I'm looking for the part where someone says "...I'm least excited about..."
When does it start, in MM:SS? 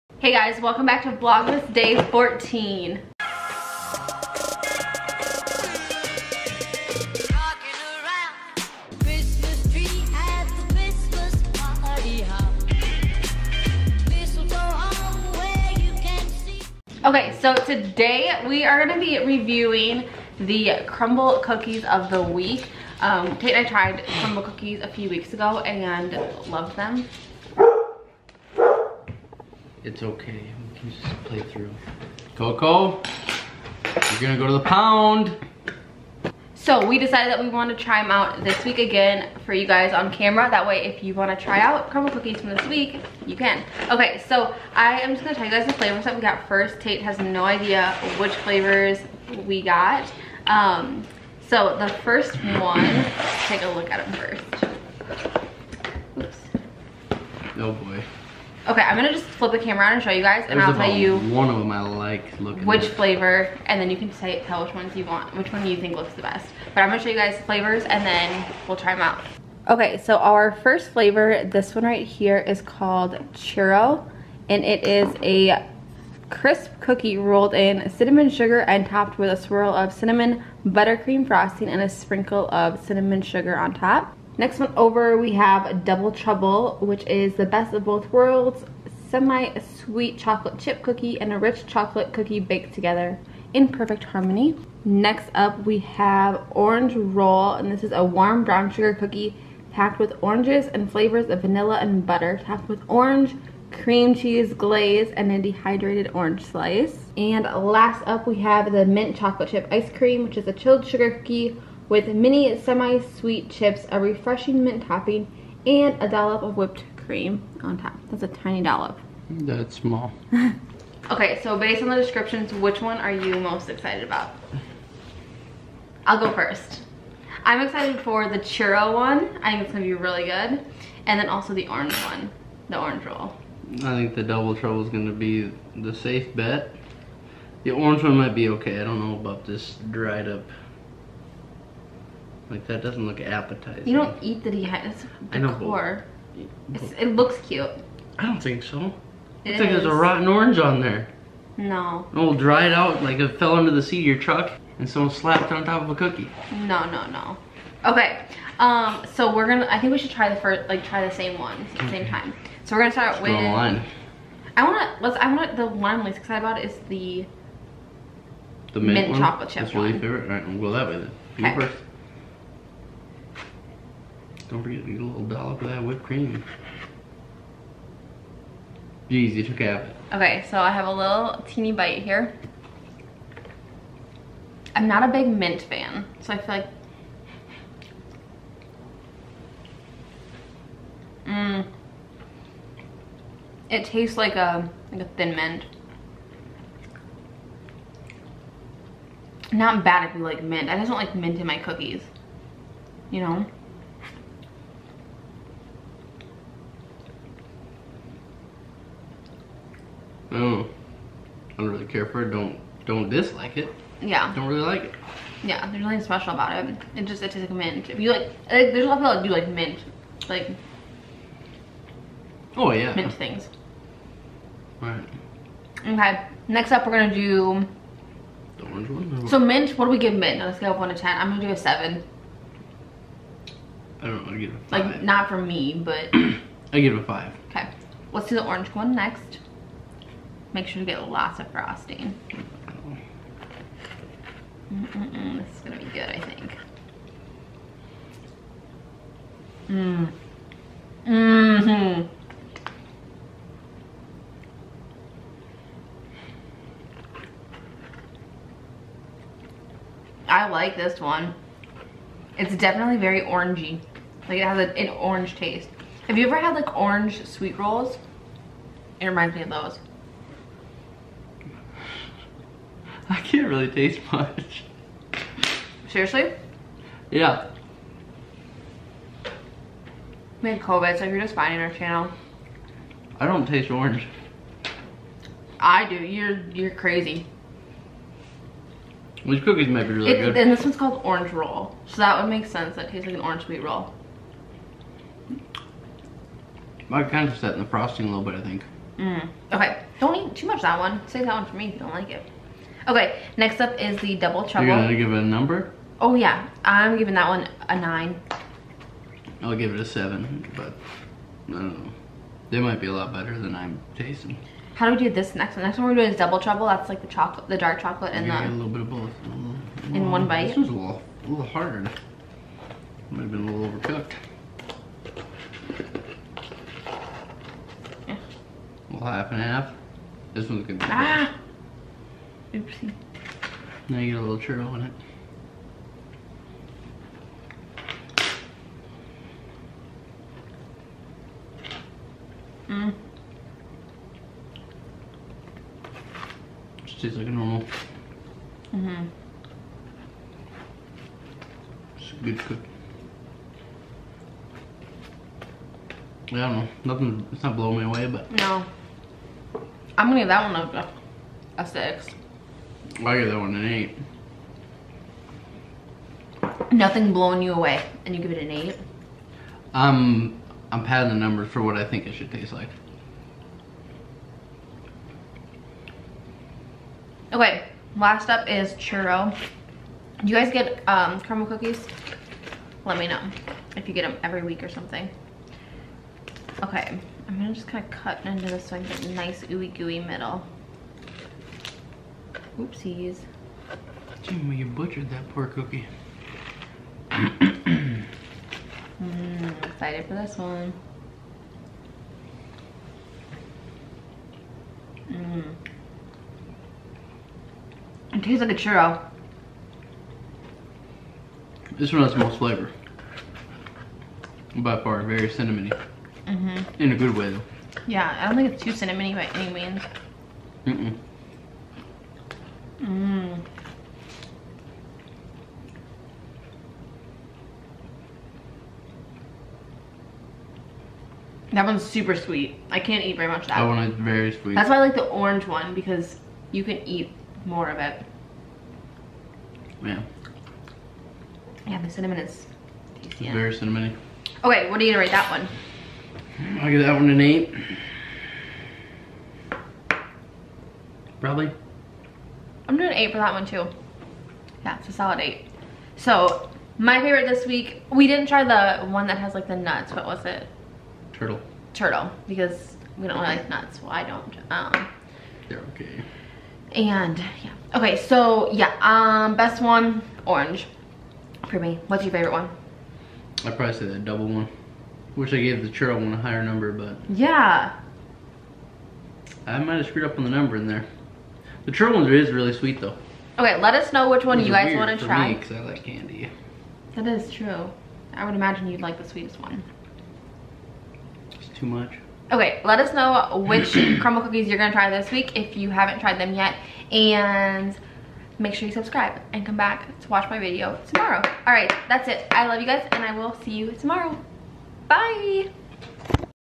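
02:46.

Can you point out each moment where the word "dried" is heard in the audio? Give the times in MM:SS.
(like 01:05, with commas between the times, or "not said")
02:19, 02:32.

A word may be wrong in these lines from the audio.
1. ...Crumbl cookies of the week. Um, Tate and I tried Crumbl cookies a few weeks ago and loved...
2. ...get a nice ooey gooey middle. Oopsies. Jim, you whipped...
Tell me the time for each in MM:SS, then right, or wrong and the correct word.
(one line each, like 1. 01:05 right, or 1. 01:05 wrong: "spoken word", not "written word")
1. 00:20 right
2. 06:28 wrong: "butchered", not "whipped".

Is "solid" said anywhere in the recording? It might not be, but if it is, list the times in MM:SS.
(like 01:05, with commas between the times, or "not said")
07:34.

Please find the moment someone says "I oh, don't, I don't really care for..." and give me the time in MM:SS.
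03:30.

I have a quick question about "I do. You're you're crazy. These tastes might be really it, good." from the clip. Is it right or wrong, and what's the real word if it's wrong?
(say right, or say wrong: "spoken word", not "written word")
wrong: "cookies", not "tastes".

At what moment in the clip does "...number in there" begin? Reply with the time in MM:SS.
08:00.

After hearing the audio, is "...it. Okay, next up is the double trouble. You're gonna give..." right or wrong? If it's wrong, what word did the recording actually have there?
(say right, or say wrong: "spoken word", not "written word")
right.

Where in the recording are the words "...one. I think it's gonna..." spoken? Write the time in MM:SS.
02:08.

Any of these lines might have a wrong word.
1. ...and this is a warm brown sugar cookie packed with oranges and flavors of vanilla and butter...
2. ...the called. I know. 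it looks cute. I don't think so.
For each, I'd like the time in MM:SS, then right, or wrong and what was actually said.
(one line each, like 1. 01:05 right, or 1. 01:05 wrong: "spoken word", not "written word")
1. 01:37 right
2. 02:24 wrong: "dehydrated", not "called".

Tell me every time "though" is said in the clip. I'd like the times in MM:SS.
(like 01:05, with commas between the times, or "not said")
06:57, 08:02.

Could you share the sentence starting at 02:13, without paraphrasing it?
I think the double trouble is gonna be the safe bet.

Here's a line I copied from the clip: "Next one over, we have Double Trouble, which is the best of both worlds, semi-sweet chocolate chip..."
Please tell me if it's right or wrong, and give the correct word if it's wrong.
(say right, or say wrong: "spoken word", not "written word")
right.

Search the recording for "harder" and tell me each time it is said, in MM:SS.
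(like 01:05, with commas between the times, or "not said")
05:21.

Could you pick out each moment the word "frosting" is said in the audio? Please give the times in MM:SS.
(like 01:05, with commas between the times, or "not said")
01:21, 04:01, 04:57.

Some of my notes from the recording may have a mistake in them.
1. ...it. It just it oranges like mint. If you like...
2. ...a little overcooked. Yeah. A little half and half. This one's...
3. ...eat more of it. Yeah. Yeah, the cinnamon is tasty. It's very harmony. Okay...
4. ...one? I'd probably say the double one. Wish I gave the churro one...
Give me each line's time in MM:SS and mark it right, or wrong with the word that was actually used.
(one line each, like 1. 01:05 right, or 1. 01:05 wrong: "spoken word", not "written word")
1. 03:36 wrong: "tastes", not "oranges"
2. 05:23 right
3. 07:16 wrong: "cinnamony", not "harmony"
4. 07:52 right.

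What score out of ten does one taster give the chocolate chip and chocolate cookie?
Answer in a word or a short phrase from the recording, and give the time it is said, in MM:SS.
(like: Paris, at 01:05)
6, at 06:01.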